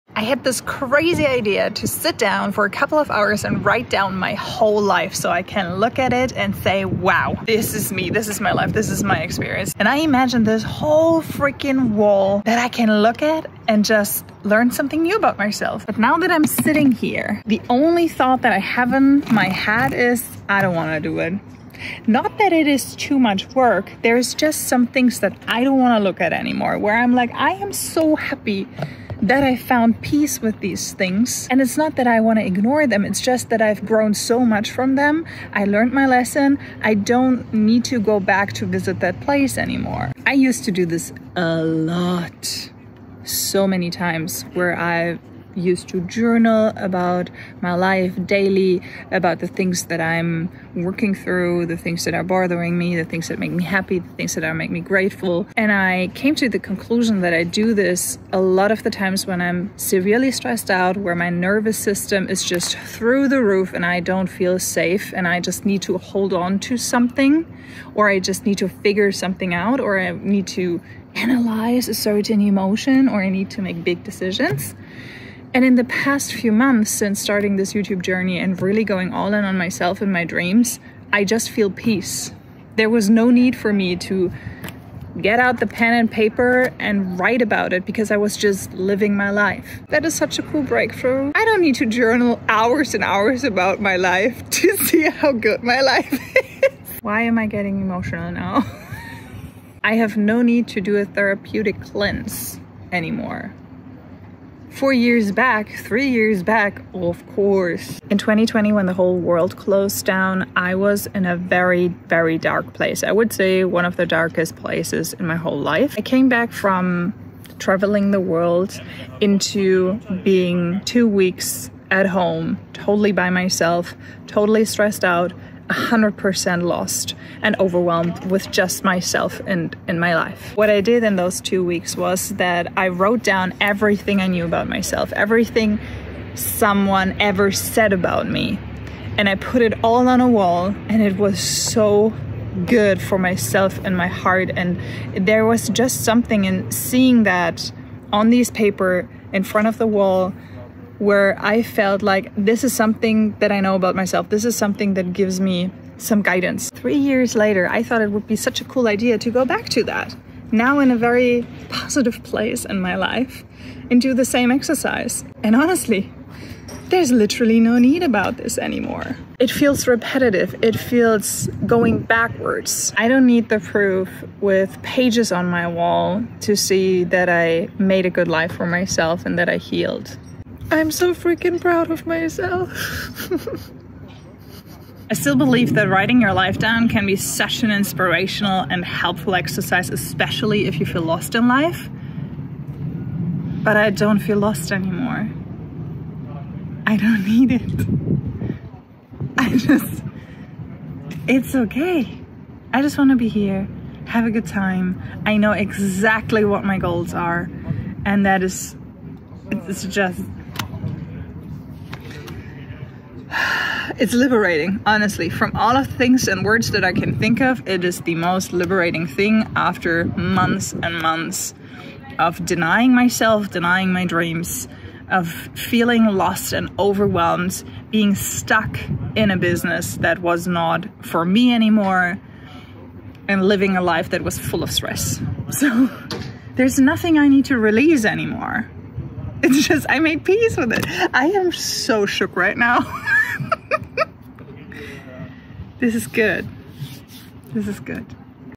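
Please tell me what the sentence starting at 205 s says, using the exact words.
I know exactly what my goals are, and that is, it's just it's liberating, honestly.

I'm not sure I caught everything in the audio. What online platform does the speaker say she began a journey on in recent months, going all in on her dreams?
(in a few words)
YouTube.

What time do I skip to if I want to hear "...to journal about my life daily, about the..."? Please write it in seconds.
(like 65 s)
45 s.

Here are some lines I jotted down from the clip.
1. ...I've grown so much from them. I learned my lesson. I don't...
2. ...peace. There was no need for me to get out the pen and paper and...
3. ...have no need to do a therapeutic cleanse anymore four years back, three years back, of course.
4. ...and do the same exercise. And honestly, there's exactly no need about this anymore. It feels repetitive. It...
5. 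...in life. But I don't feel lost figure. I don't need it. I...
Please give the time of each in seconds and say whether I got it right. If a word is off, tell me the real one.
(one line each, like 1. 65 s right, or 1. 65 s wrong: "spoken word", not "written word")
1. 33 s right
2. 81 s right
3. 99 s right
4. 163 s wrong: "literally", not "exactly"
5. 191 s wrong: "anymore", not "figure".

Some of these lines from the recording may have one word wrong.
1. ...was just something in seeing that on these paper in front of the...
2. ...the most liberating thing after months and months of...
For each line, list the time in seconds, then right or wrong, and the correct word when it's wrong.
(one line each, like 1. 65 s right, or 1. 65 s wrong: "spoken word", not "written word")
1. 145 s right
2. 218 s right.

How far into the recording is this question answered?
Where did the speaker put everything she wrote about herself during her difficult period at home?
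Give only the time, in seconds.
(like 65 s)
140 s.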